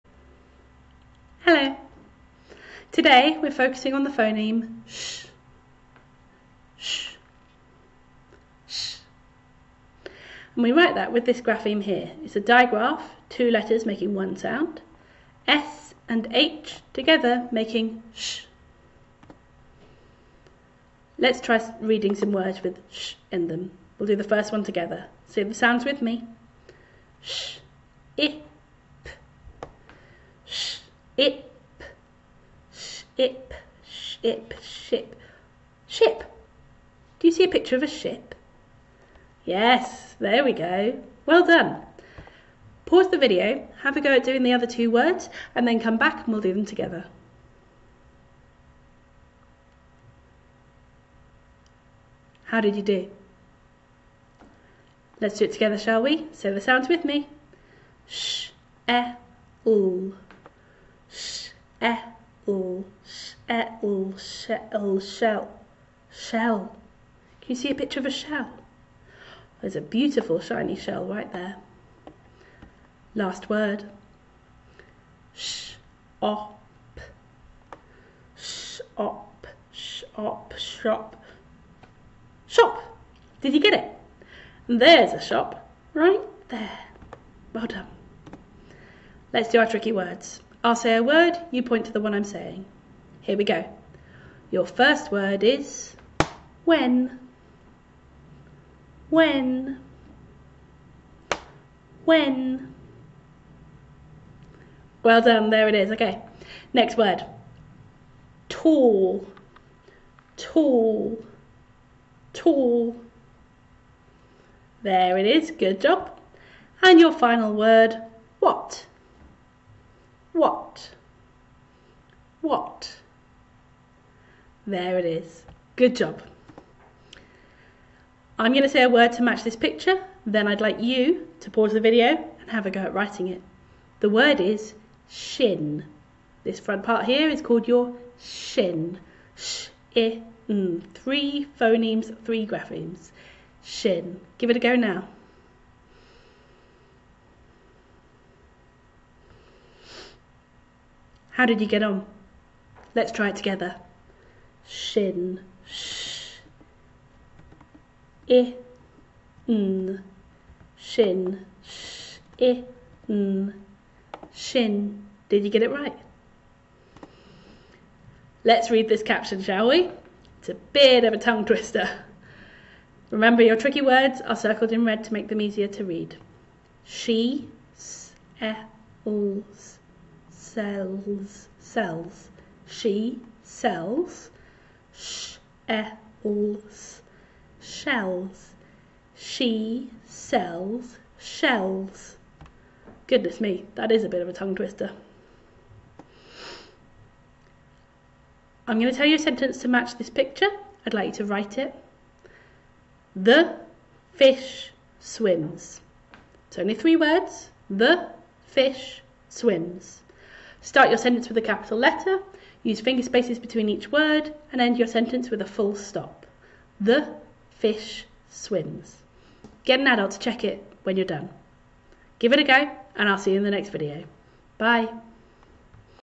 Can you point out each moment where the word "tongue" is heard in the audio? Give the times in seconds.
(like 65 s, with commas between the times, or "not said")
171 s, 194 s.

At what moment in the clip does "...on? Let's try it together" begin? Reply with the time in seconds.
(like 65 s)
151 s.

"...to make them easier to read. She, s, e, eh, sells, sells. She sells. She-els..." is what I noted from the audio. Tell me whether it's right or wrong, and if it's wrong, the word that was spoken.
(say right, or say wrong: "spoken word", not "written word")
right.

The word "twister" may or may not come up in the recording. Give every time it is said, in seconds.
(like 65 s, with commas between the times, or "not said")
171 s, 194 s.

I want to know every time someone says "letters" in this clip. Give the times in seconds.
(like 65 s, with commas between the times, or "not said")
13 s, 211 s.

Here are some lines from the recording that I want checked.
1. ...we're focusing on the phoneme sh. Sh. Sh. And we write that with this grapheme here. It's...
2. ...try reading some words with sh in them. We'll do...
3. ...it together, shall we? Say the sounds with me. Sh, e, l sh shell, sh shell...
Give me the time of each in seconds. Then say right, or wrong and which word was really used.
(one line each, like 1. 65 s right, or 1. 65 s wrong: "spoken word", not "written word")
1. 3 s right
2. 21 s right
3. 55 s right.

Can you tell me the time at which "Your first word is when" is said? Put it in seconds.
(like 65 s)
94 s.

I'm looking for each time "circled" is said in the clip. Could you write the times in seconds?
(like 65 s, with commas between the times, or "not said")
174 s.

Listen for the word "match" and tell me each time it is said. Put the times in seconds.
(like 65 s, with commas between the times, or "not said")
129 s, 199 s.